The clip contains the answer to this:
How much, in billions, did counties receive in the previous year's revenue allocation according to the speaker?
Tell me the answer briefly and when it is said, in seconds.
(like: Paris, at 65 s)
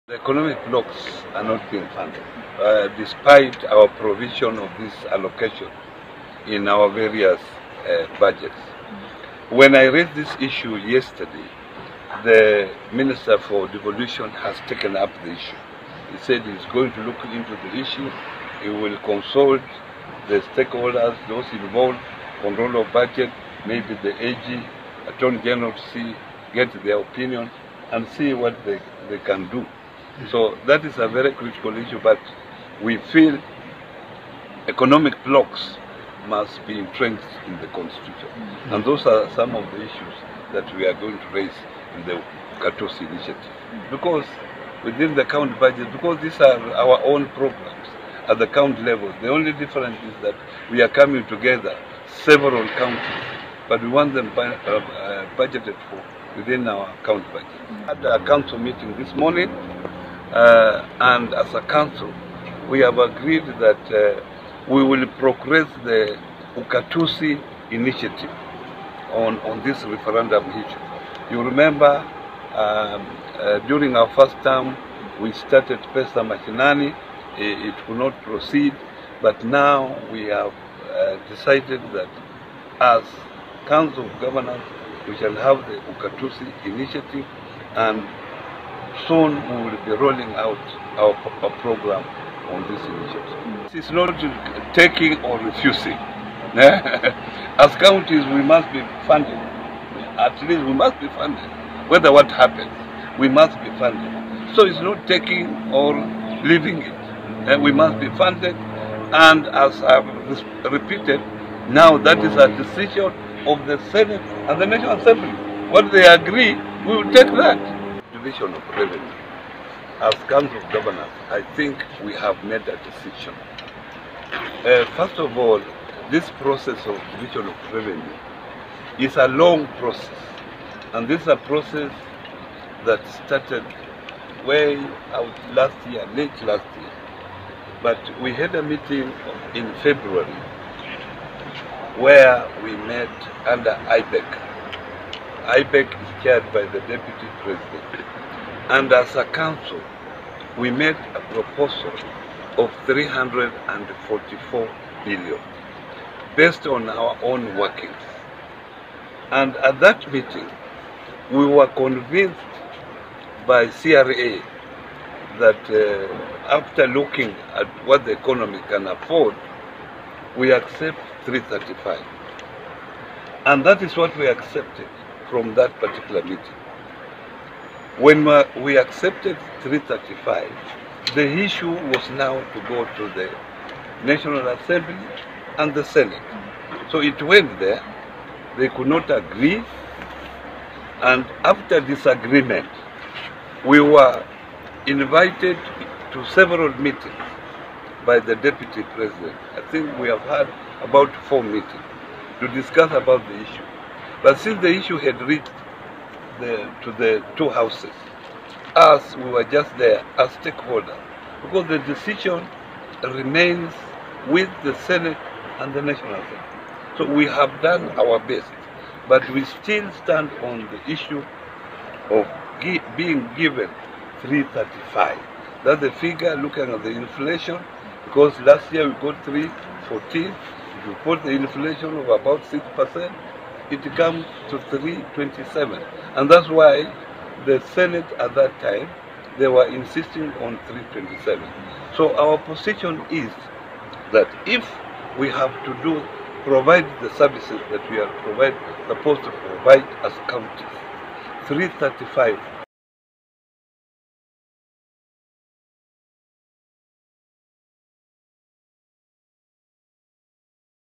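314, at 229 s.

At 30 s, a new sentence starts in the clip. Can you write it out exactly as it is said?
So that is a very critical issue, but we feel economic blocks must be entrenched in the constitution.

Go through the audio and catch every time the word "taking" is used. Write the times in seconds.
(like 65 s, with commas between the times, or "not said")
94 s, 105 s.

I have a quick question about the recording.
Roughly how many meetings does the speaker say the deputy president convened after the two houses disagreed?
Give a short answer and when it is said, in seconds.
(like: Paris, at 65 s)
4, at 201 s.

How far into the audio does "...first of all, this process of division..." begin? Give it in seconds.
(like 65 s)
124 s.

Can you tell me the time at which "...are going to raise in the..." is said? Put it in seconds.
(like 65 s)
40 s.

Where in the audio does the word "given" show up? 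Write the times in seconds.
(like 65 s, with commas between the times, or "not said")
223 s.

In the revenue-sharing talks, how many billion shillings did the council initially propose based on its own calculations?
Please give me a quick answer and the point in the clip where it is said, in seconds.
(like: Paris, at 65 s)
344 billion, at 152 s.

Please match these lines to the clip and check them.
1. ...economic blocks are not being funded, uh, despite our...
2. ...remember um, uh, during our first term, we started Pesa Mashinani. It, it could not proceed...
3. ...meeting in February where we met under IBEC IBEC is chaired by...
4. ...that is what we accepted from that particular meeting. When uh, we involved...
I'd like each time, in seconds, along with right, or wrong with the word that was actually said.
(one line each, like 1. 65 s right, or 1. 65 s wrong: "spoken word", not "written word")
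1. 0 s right
2. 71 s right
3. 138 s right
4. 173 s wrong: "accepted", not "involved".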